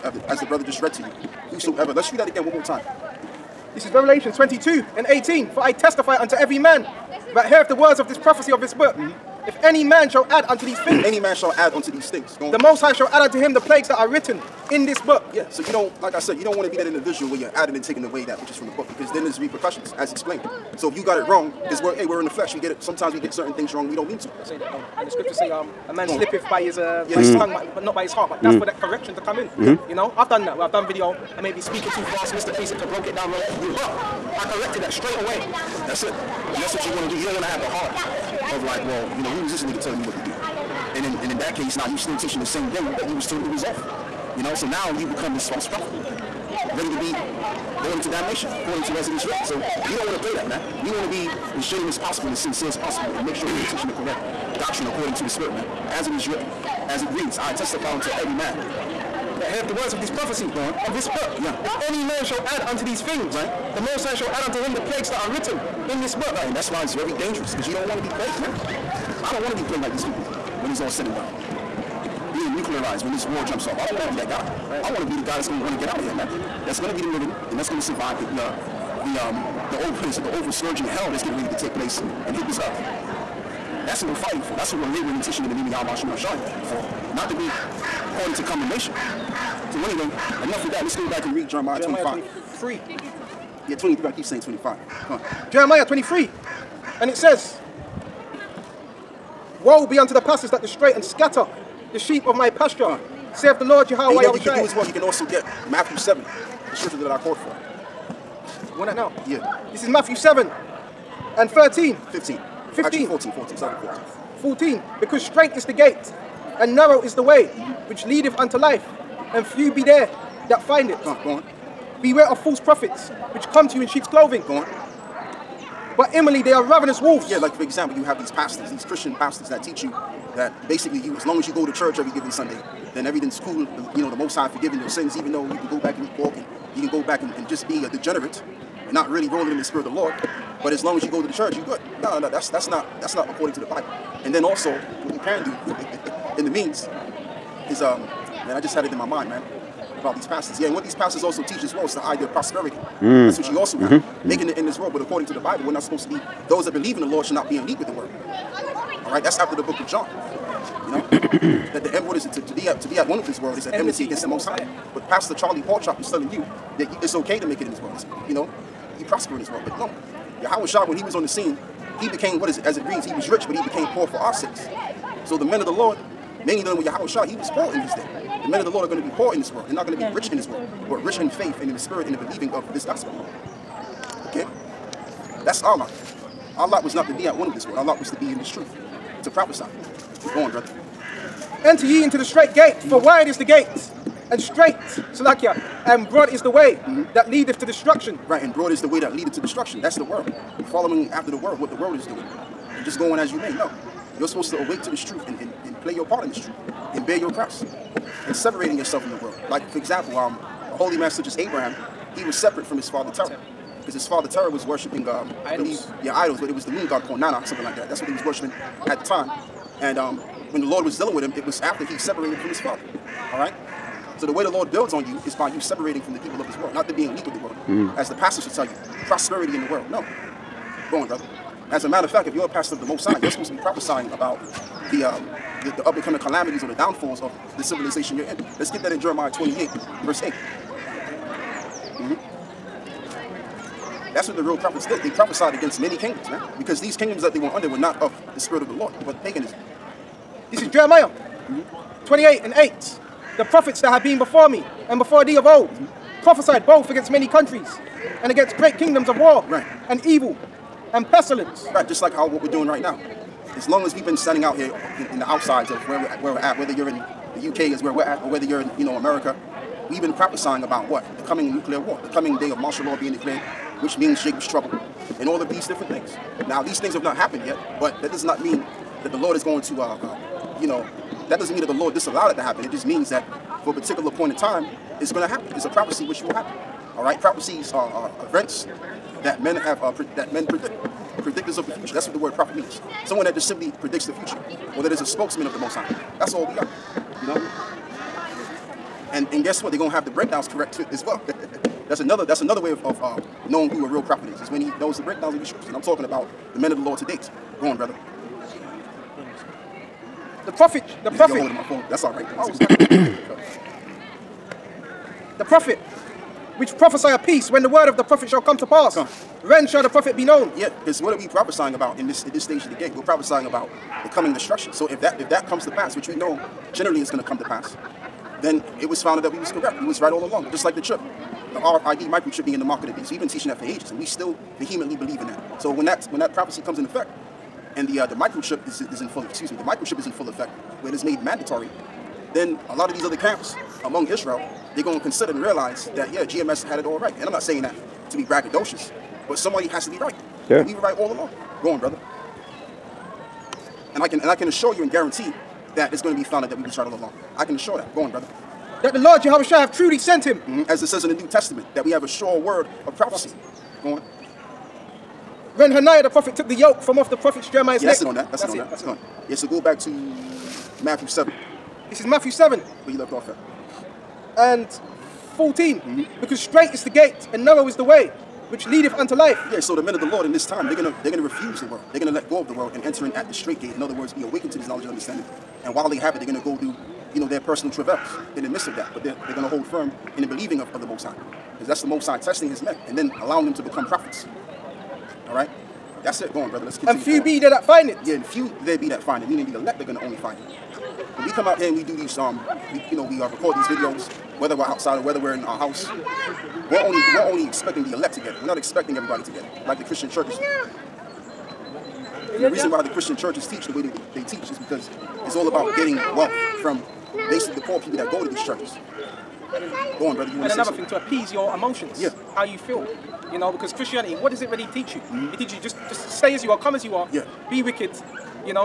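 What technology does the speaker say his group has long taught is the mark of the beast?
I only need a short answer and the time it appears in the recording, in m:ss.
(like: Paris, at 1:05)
RFID microchip, at 5:31.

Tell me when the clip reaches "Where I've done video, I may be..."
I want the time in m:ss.
0:30.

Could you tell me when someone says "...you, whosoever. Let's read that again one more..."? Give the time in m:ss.
0:01.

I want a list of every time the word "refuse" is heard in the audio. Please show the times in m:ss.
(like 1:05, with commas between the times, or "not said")
6:21.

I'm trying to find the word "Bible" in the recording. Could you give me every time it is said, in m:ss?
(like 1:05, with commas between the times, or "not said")
2:23, 2:35.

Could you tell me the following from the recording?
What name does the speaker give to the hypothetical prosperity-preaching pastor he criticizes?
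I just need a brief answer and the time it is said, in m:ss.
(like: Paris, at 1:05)
Pastor Charlie Porchop, at 2:45.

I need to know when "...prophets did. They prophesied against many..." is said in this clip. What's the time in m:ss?
4:04.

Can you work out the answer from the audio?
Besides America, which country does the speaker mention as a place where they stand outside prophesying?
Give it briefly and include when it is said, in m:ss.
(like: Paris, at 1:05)
UK, at 4:27.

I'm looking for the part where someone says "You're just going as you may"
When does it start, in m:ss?
3:22.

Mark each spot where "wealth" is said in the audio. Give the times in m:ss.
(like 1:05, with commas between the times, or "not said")
6:55.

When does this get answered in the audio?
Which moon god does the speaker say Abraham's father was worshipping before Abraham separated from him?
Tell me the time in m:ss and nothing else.
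3:37.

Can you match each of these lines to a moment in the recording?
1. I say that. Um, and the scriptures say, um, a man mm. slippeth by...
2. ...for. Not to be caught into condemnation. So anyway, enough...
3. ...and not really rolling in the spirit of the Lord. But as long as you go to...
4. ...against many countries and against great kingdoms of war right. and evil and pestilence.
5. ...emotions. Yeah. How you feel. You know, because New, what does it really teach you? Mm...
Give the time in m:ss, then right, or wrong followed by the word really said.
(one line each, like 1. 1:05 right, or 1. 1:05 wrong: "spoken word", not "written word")
1. 0:24 right
2. 1:26 right
3. 2:18 right
4. 4:16 right
5. 7:01 wrong: "Christianity", not "New".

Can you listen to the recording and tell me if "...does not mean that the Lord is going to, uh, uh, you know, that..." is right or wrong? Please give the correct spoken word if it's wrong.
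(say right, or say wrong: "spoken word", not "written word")
right.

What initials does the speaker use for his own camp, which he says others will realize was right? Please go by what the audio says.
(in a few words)
GMS.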